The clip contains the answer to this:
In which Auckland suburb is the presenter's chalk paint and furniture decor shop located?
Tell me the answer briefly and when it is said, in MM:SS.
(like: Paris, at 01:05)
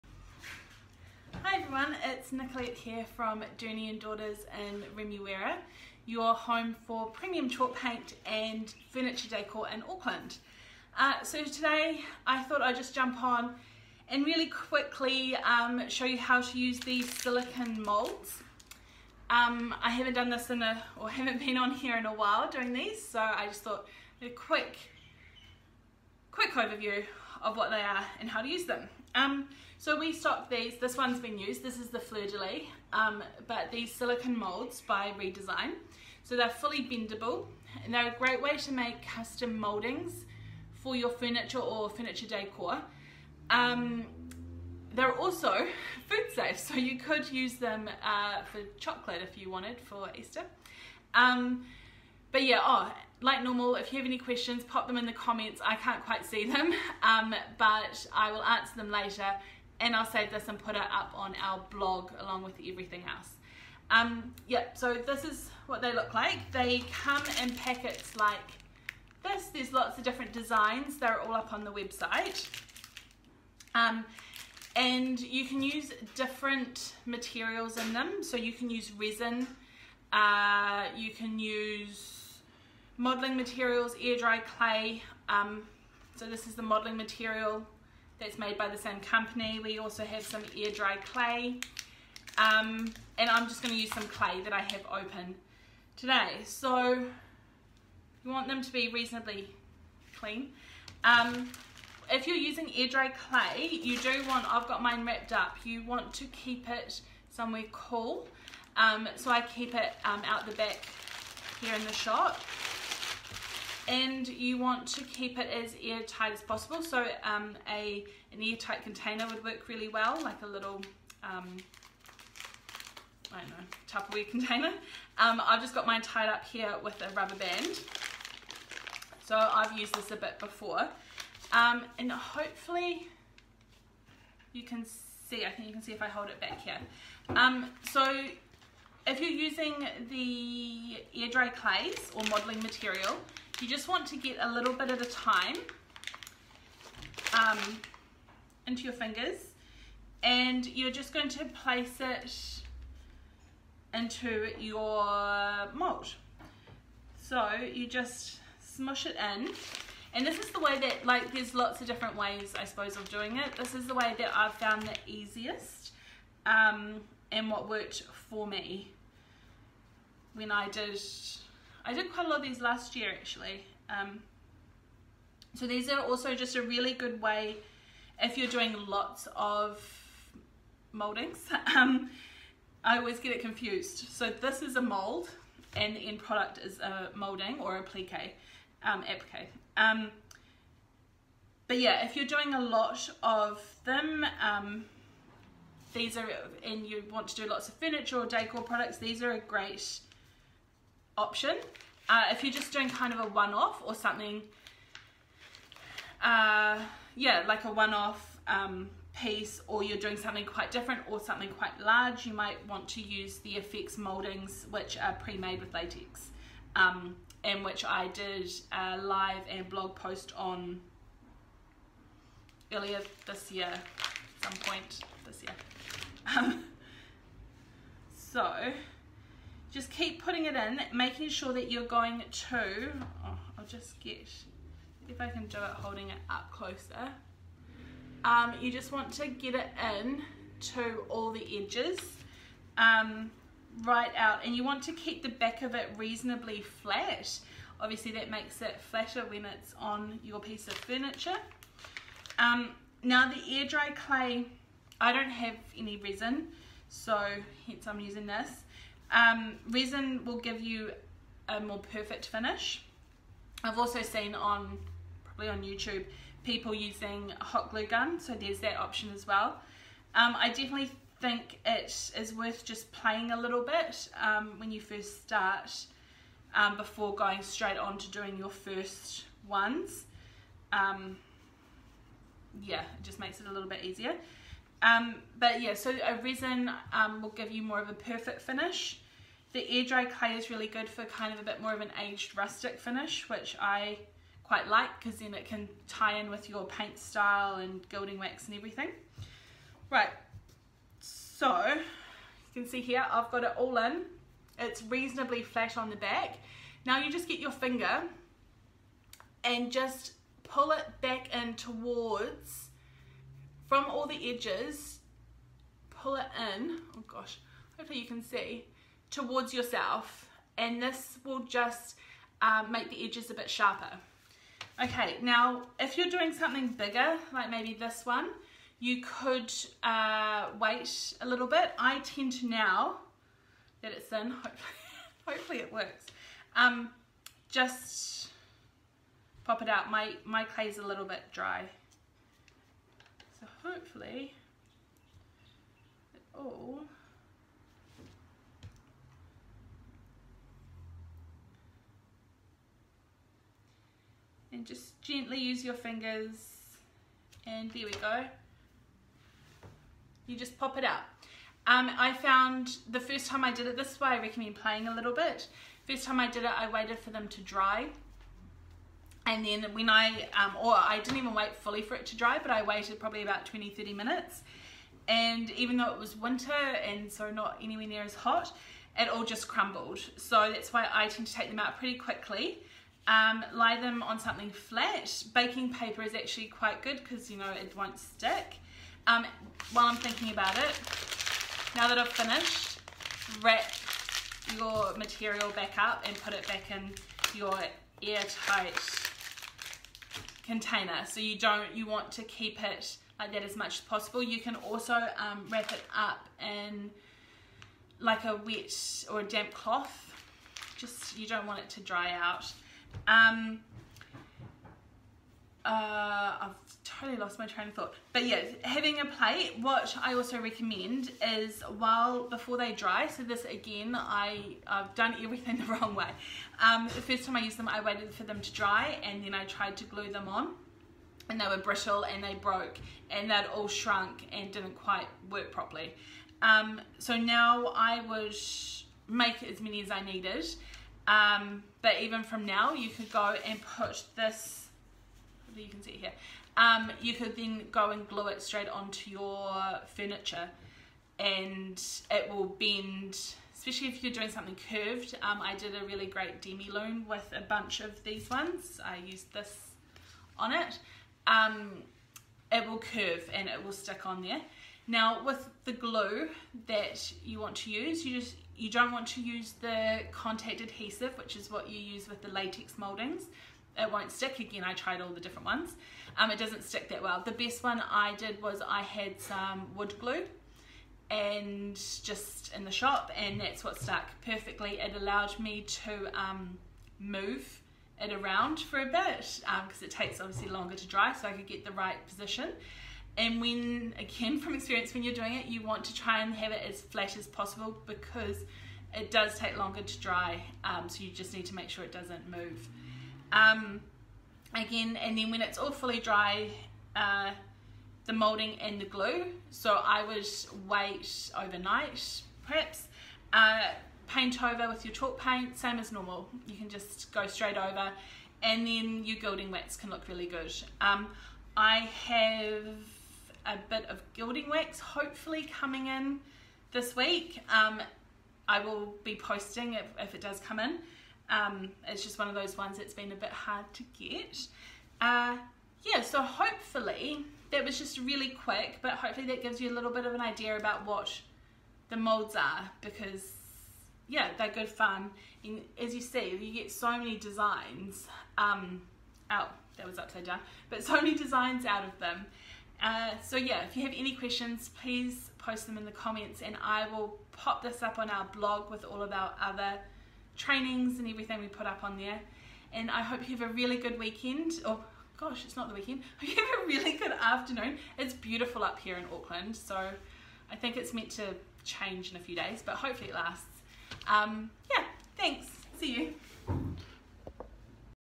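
Remuera, at 00:04.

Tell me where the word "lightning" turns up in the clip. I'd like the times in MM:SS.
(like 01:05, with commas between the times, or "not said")
not said.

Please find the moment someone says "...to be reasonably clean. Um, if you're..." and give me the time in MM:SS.
01:38.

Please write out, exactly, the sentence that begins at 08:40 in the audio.
Um, I have a bit of gilding wax hopefully coming in this week.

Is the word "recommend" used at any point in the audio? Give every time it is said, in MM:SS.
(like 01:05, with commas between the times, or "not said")
06:04, 07:00.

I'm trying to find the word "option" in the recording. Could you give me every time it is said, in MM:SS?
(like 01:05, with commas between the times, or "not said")
03:21, 04:28.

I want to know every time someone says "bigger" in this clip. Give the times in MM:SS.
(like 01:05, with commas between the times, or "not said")
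05:26.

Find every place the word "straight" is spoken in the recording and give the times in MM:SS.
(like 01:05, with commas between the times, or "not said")
04:37, 07:28, 08:37.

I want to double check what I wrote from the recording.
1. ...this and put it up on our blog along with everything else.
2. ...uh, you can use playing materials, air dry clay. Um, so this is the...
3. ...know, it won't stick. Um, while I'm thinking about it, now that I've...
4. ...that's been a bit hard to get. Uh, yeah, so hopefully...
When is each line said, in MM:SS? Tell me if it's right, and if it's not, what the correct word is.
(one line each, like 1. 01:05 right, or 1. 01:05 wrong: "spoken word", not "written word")
1. 01:00 right
2. 01:20 wrong: "modeling", not "playing"
3. 06:27 right
4. 08:52 right.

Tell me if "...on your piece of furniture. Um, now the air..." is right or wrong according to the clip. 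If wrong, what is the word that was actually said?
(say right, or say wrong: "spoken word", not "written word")
right.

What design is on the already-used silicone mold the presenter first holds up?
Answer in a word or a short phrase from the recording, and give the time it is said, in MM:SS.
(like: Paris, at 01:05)
fleur-de-lis, at 00:31.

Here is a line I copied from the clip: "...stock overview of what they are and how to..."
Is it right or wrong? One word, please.
wrong.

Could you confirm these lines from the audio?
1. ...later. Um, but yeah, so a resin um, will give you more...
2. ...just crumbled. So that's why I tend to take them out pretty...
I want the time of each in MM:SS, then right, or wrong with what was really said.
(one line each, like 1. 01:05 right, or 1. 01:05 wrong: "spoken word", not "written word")
1. 04:43 wrong: "easier", not "later"
2. 06:19 right.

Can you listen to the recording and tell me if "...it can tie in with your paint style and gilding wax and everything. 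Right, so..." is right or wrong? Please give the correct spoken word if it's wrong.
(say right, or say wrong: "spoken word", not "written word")
right.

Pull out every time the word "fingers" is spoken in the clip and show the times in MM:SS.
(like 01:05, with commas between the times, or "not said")
02:28, 05:07, 05:55.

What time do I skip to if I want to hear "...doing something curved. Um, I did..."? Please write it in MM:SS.
07:34.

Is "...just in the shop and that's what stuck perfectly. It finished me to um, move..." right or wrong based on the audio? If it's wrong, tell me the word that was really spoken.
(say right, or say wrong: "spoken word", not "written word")
wrong: "allowed", not "finished".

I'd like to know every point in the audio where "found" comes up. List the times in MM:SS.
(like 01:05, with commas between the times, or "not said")
02:44, 06:02.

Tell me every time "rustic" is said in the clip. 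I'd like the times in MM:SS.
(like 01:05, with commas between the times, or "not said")
04:52.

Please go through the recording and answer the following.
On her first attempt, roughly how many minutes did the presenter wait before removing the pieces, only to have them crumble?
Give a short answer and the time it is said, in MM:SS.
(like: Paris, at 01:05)
20 to 30 minutes, at 06:13.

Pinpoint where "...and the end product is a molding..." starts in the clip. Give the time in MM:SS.
03:05.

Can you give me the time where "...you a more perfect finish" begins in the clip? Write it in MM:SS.
04:20.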